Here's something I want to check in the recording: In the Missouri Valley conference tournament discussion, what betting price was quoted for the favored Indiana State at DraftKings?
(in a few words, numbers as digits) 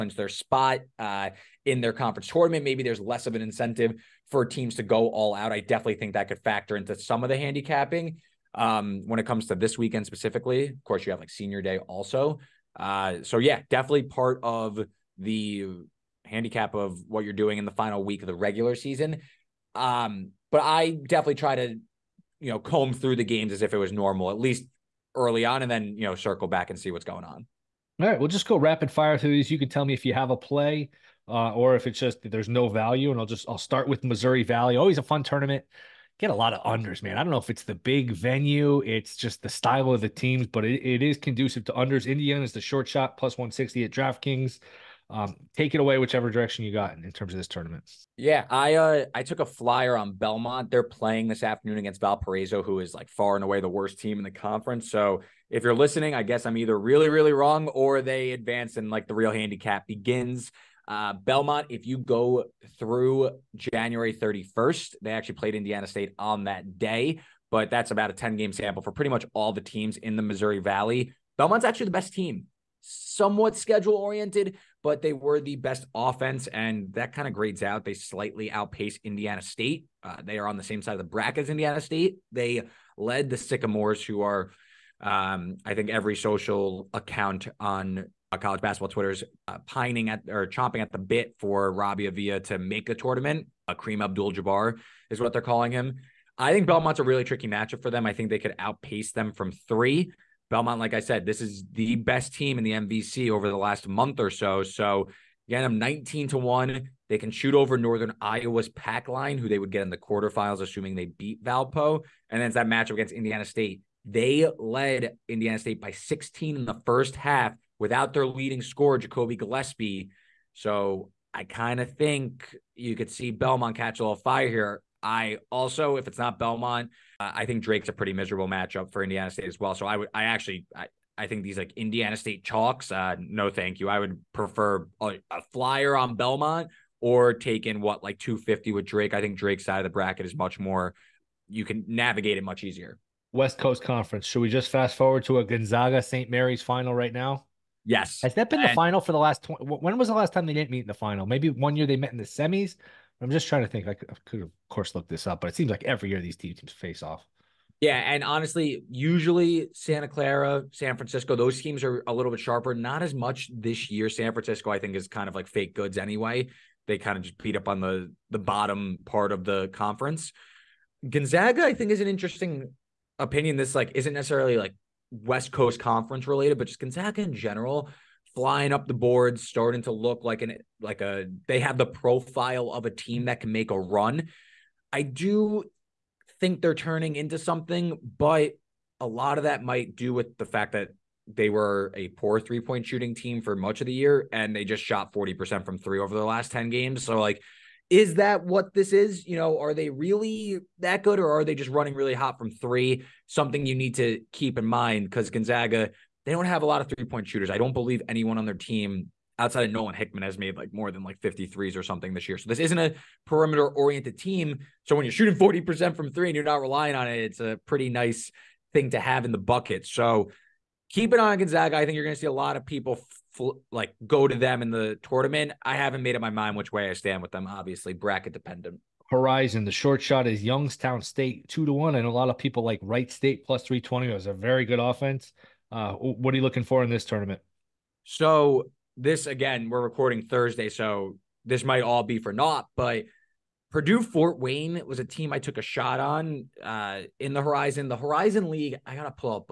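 +160.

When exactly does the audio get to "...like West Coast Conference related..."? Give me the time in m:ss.
2:54.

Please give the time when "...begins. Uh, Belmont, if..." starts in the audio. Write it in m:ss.
0:59.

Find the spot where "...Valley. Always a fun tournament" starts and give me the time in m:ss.
0:34.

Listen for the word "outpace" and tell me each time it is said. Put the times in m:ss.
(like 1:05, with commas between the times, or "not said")
1:18, 1:38.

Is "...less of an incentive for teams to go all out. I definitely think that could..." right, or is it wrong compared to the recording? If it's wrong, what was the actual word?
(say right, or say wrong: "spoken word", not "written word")
right.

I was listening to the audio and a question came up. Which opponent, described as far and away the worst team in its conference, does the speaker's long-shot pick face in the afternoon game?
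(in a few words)
Valparaiso.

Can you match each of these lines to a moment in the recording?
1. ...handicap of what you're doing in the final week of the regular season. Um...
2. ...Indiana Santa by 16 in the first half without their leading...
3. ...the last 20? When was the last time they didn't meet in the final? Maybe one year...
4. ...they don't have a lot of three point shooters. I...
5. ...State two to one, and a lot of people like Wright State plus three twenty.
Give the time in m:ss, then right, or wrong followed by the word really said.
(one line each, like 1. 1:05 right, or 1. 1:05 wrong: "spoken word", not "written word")
1. 0:16 right
2. 1:55 wrong: "State", not "Santa"
3. 2:29 right
4. 3:26 right
5. 3:51 right.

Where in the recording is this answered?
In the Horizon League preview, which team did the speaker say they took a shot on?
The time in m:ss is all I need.
4:03.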